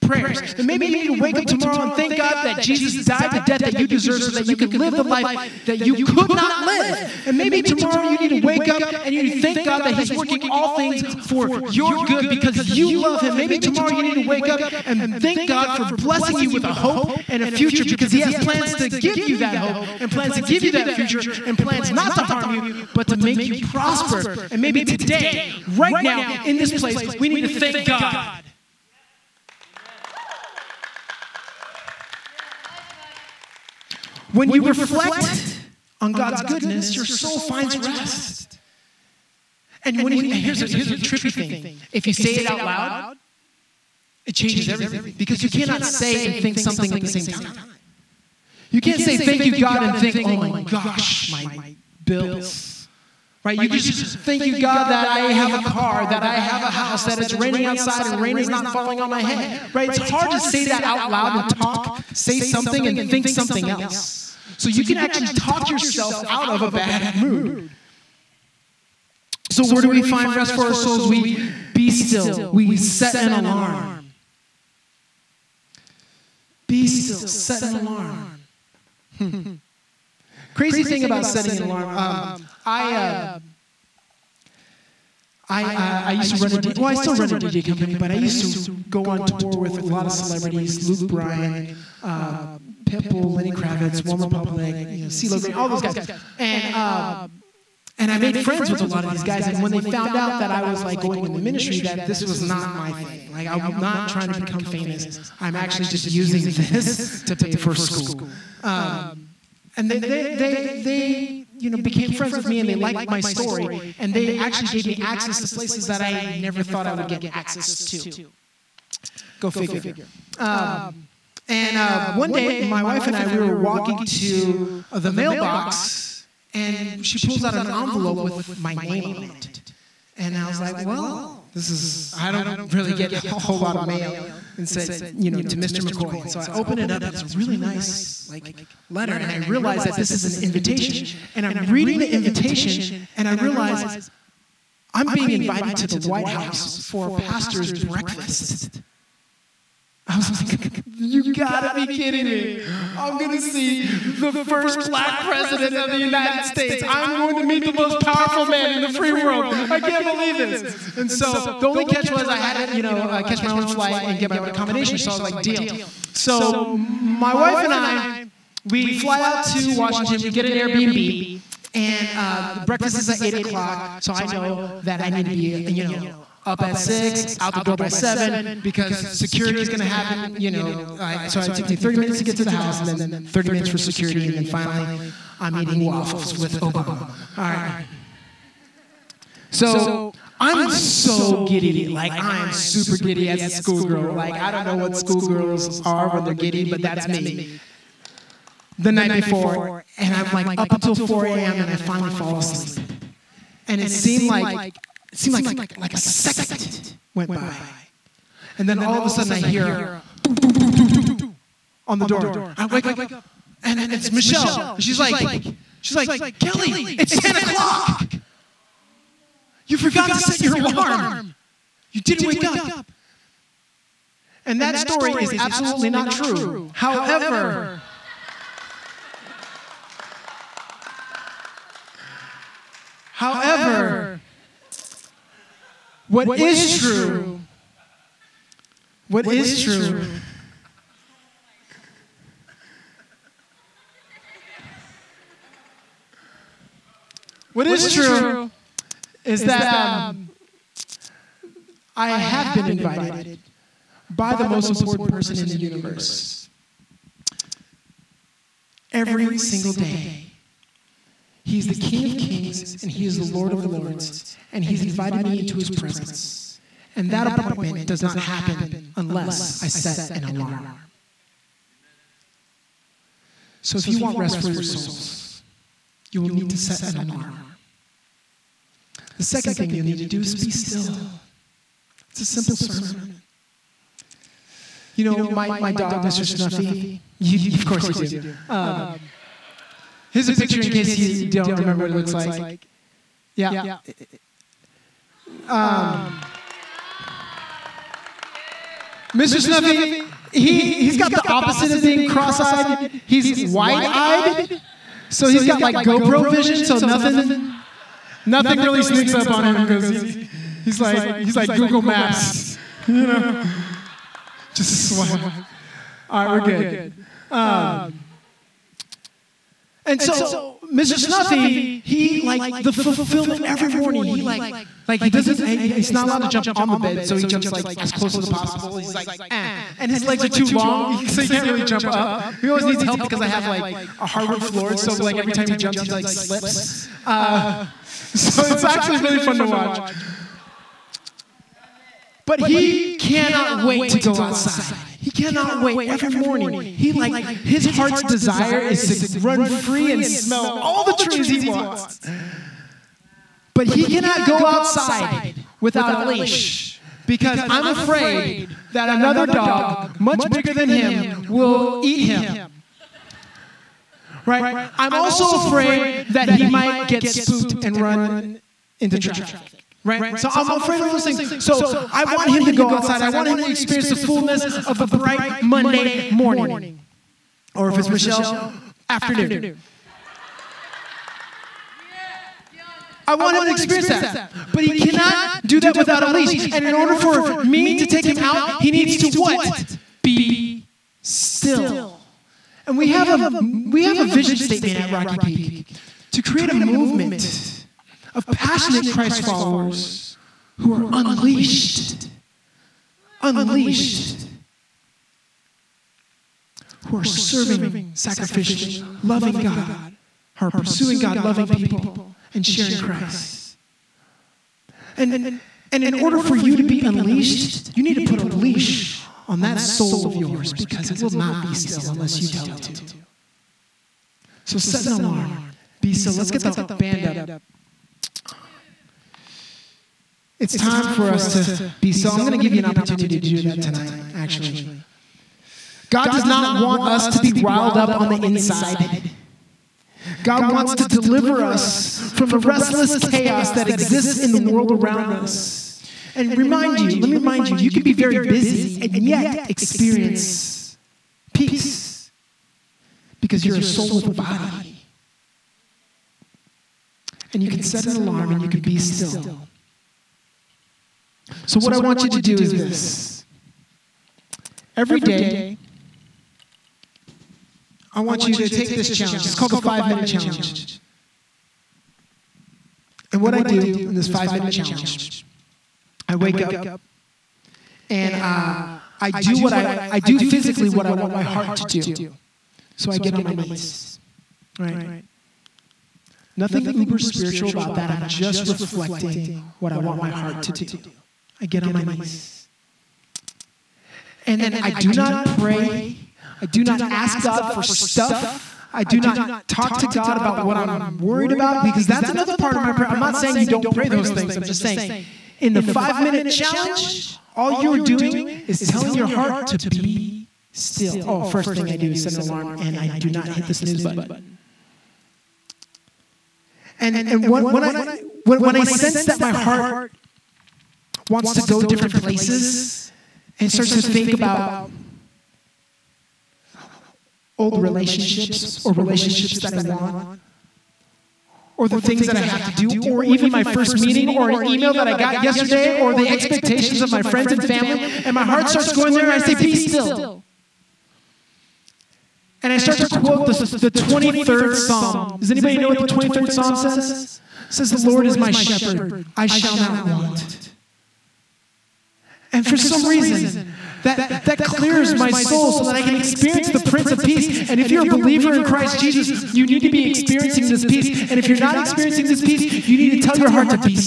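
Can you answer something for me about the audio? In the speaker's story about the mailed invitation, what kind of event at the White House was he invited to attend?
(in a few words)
pastor's breakfast.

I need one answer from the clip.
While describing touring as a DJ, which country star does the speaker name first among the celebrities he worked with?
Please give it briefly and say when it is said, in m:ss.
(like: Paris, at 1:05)
Luke Bryan, at 1:30.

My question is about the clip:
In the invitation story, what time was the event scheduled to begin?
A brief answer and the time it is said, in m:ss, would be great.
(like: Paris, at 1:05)
8:00, at 2:53.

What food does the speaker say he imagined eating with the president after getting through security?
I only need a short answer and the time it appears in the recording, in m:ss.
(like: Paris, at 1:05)
waffles, at 3:05.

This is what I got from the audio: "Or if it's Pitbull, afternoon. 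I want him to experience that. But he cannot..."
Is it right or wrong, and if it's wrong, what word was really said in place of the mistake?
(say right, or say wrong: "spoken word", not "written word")
wrong: "Michelle", not "Pitbull".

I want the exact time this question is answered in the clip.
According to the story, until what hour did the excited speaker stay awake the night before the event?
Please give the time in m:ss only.
3:20.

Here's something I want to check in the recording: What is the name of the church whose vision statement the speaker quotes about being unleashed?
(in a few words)
Rocky Peak.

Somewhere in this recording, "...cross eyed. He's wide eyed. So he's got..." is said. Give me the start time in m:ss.
5:02.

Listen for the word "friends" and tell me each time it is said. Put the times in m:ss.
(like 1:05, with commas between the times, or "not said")
1:38, 1:52, 8:57.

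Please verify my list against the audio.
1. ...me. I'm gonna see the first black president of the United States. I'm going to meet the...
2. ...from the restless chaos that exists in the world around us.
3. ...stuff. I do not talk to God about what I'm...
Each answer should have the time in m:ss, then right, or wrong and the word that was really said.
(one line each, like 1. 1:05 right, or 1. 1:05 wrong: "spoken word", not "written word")
1. 2:32 right
2. 7:22 right
3. 8:17 right.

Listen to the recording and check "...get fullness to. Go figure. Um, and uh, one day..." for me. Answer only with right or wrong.
wrong.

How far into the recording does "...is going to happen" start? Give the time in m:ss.
2:59.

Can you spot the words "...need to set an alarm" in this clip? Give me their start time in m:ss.
4:36.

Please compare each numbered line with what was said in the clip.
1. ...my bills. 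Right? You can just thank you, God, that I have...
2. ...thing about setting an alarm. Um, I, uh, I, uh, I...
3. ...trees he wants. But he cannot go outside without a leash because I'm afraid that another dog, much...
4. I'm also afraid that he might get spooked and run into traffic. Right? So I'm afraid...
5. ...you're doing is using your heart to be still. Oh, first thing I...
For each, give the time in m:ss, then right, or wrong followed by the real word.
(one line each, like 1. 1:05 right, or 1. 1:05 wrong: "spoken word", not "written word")
1. 0:51 right
2. 1:20 right
3. 5:50 right
4. 6:04 right
5. 8:27 wrong: "telling", not "using".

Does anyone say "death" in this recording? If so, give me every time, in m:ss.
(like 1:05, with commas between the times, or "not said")
0:03.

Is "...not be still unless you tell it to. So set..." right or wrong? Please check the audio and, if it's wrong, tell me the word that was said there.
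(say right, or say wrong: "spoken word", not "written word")
right.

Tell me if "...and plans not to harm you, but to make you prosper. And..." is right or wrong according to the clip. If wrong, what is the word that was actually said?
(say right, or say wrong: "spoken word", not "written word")
right.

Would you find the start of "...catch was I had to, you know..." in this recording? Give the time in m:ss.
2:41.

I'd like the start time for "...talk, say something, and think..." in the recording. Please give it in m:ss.
1:01.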